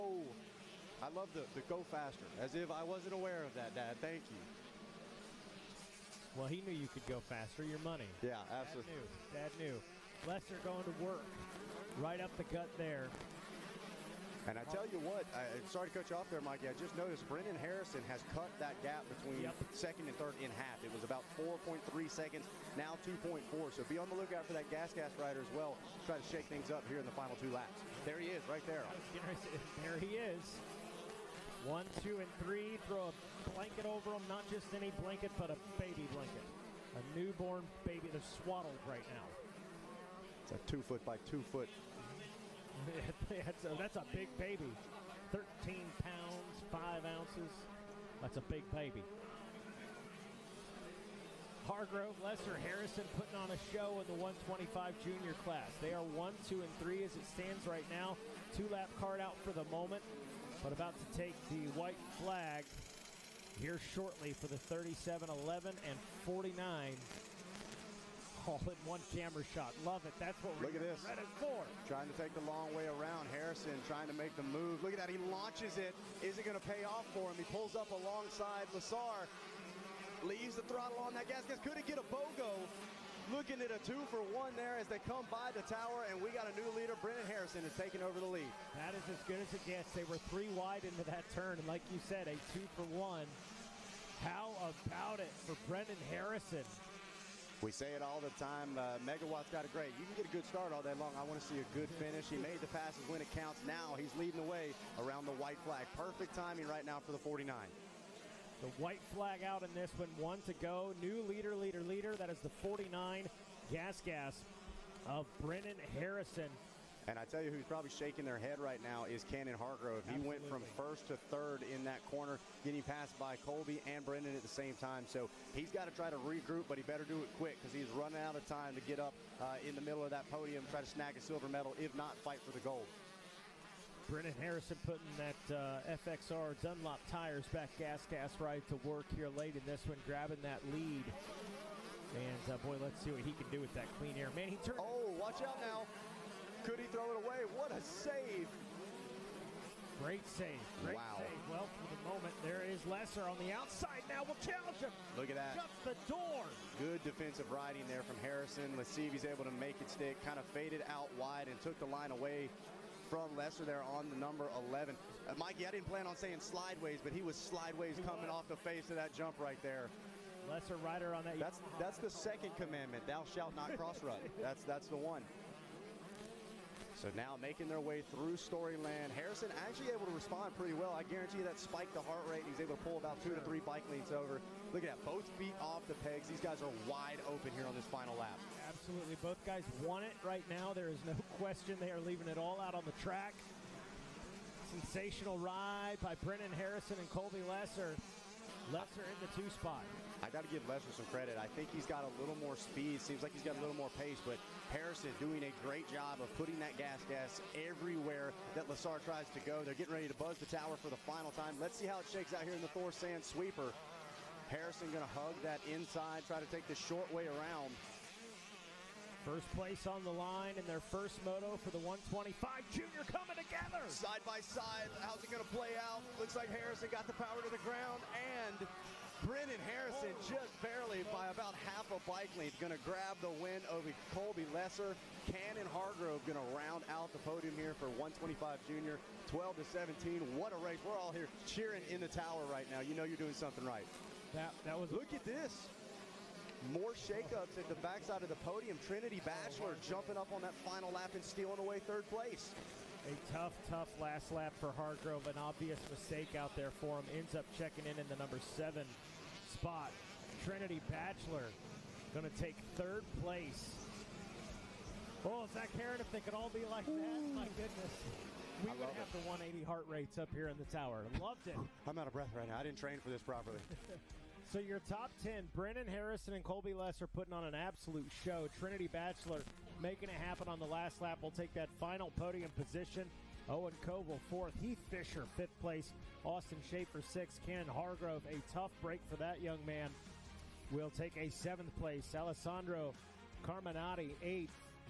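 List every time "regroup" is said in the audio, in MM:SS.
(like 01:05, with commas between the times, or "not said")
02:06.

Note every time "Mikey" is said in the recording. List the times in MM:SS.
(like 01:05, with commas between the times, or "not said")
00:16, 02:45.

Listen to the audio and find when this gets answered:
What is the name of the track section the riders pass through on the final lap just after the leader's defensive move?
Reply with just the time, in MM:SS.
02:58.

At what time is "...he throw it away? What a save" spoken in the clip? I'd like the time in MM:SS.
02:26.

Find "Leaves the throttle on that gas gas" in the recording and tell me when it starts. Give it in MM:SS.
01:20.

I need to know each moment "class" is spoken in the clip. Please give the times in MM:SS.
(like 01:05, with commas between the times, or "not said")
00:55.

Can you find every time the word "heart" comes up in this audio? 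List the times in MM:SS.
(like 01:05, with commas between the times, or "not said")
03:02, 04:29.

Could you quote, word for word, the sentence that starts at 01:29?
They were three wide into that turn, and like you said, a two for one.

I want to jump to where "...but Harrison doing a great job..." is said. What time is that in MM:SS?
03:24.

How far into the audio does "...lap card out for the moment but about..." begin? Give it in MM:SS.
00:58.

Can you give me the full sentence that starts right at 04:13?
A tough, tough last lap for Hargrove.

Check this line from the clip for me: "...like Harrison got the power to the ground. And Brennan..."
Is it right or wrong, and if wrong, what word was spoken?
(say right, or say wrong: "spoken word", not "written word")
right.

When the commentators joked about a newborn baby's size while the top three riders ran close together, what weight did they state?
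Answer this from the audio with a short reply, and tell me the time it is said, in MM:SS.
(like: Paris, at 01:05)
13 pounds, 5 ounces, at 00:45.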